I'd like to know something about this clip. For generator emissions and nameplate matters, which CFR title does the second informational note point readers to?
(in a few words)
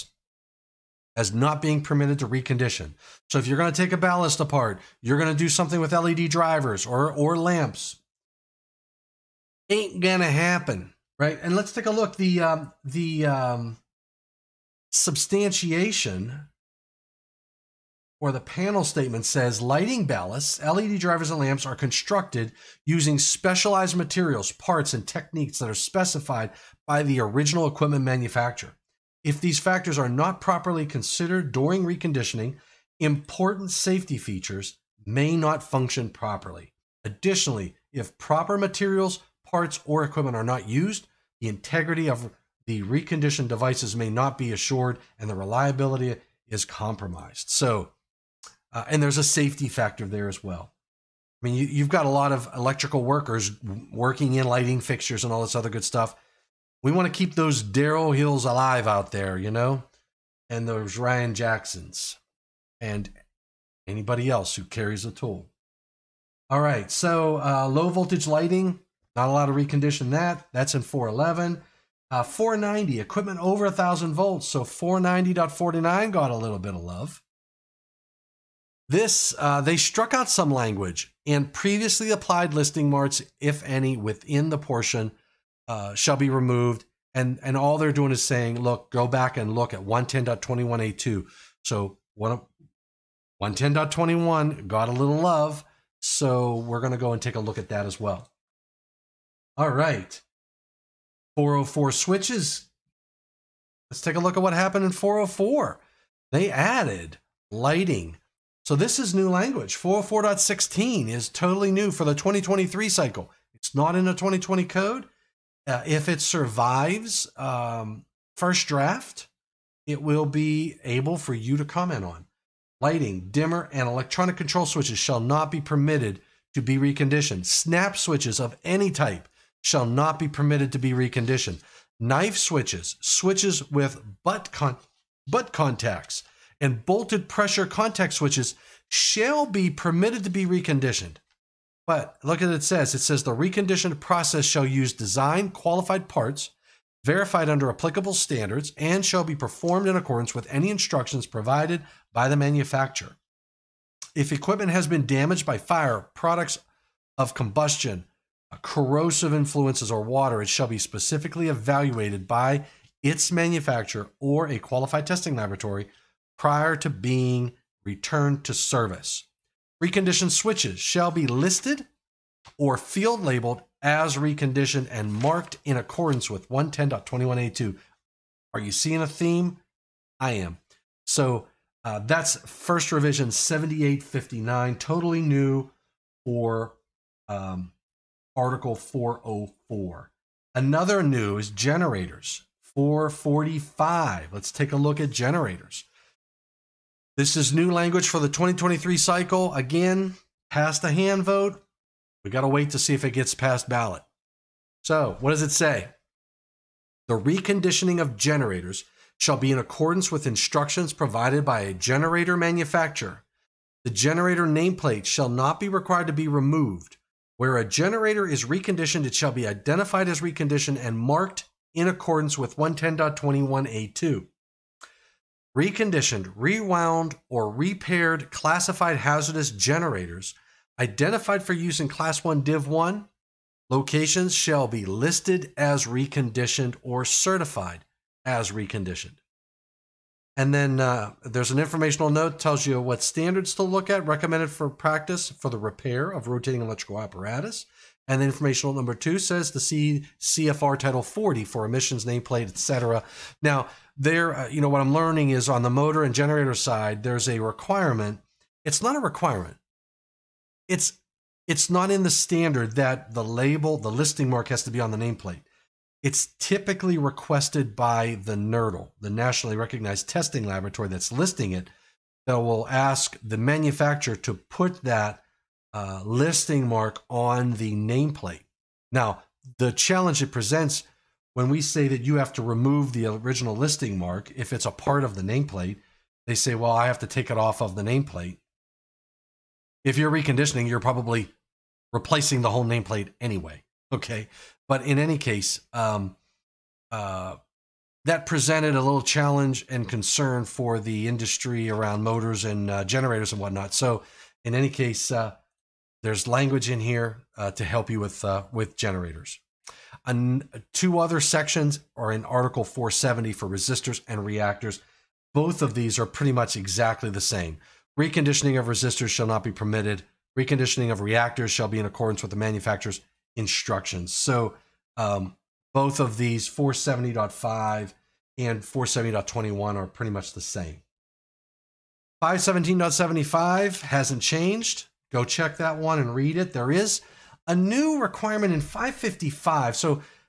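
Title 40.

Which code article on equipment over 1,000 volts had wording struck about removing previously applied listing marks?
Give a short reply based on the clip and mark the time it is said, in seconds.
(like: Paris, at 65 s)
490, at 72 s.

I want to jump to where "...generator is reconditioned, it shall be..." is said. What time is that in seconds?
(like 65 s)
217 s.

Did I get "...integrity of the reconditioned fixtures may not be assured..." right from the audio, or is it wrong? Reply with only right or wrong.
wrong.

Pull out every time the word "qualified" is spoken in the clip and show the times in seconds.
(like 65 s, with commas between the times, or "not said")
145 s, 164 s.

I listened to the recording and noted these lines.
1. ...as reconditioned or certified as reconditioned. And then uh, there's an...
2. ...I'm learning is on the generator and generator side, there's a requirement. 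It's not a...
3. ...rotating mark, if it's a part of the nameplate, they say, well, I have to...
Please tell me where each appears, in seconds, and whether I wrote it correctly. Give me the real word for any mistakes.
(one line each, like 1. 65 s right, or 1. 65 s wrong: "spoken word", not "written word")
1. 235 s right
2. 254 s wrong: "motor", not "generator"
3. 283 s wrong: "listing", not "rotating".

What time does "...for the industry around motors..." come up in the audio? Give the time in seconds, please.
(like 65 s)
300 s.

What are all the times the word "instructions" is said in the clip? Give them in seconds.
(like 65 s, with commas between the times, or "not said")
150 s, 210 s, 323 s.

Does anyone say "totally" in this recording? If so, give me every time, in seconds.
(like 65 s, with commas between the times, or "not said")
111 s, 184 s.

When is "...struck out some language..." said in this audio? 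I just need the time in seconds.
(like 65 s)
79 s.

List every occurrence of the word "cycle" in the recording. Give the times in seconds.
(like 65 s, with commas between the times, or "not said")
112 s, 198 s.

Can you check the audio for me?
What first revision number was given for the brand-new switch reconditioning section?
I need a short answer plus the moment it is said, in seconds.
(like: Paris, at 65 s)
7859, at 183 s.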